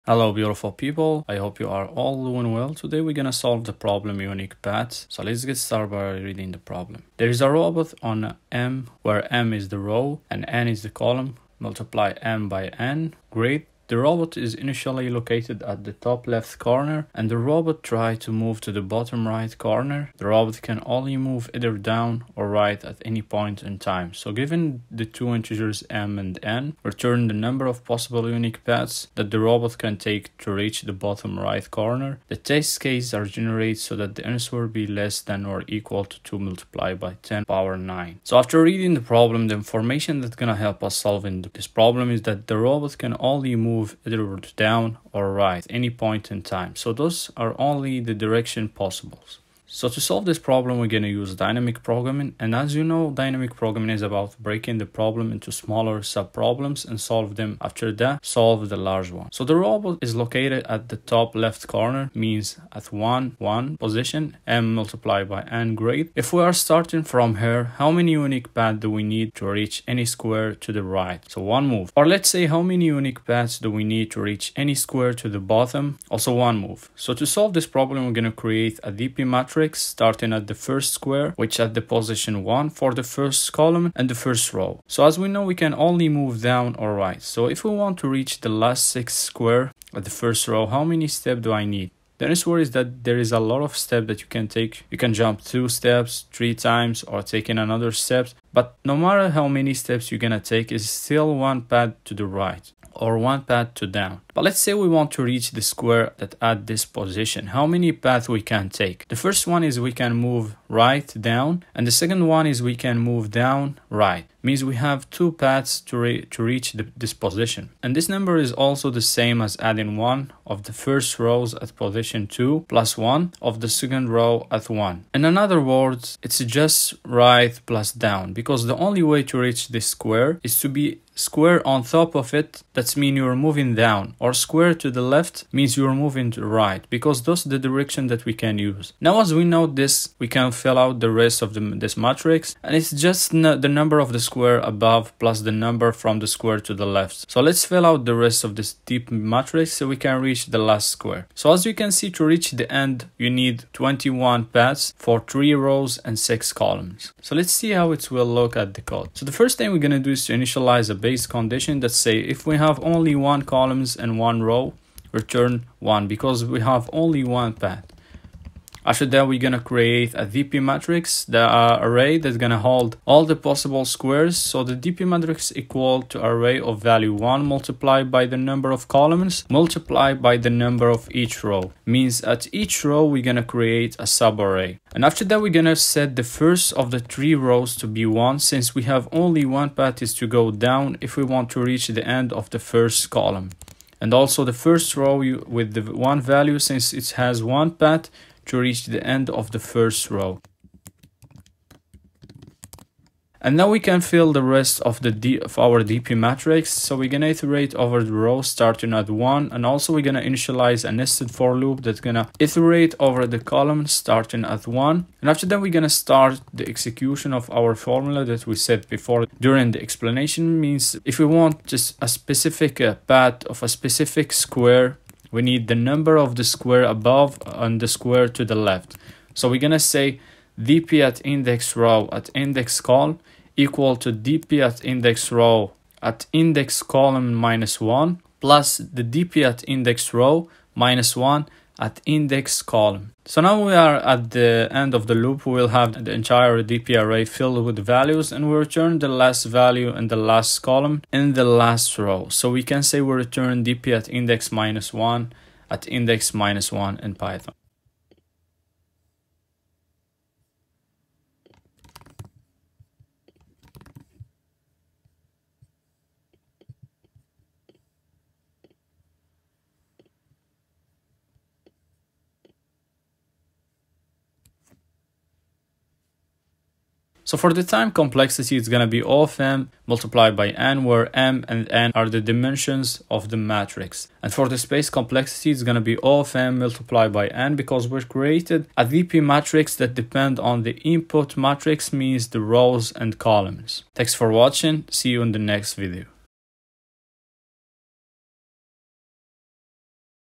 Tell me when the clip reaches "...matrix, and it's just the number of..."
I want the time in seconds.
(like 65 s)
141 s.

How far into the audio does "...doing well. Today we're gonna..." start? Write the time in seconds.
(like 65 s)
2 s.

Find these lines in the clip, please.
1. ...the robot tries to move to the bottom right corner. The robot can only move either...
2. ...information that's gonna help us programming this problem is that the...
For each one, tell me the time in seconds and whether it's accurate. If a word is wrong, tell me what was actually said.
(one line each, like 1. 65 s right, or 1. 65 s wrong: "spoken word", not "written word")
1. 17 s right
2. 39 s wrong: "solving", not "programming".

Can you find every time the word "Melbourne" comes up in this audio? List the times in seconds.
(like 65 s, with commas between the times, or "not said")
not said.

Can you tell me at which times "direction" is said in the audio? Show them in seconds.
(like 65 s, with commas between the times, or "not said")
48 s, 137 s.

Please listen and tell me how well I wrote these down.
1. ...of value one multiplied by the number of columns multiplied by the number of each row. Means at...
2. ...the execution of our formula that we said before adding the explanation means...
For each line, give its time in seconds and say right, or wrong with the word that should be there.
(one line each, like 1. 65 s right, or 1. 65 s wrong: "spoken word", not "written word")
1. 176 s right
2. 216 s wrong: "during", not "adding".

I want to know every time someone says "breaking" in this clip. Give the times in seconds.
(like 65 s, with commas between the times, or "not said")
54 s.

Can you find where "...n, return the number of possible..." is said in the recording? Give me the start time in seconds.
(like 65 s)
26 s.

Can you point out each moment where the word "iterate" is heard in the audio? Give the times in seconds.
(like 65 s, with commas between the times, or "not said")
207 s, 212 s.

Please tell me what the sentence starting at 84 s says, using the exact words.
So as we know, we can only move down or right.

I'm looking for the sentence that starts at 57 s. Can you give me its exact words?
After that, solve the large one.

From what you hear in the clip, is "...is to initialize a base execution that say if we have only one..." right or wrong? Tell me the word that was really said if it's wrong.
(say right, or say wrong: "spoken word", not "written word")
wrong: "condition", not "execution".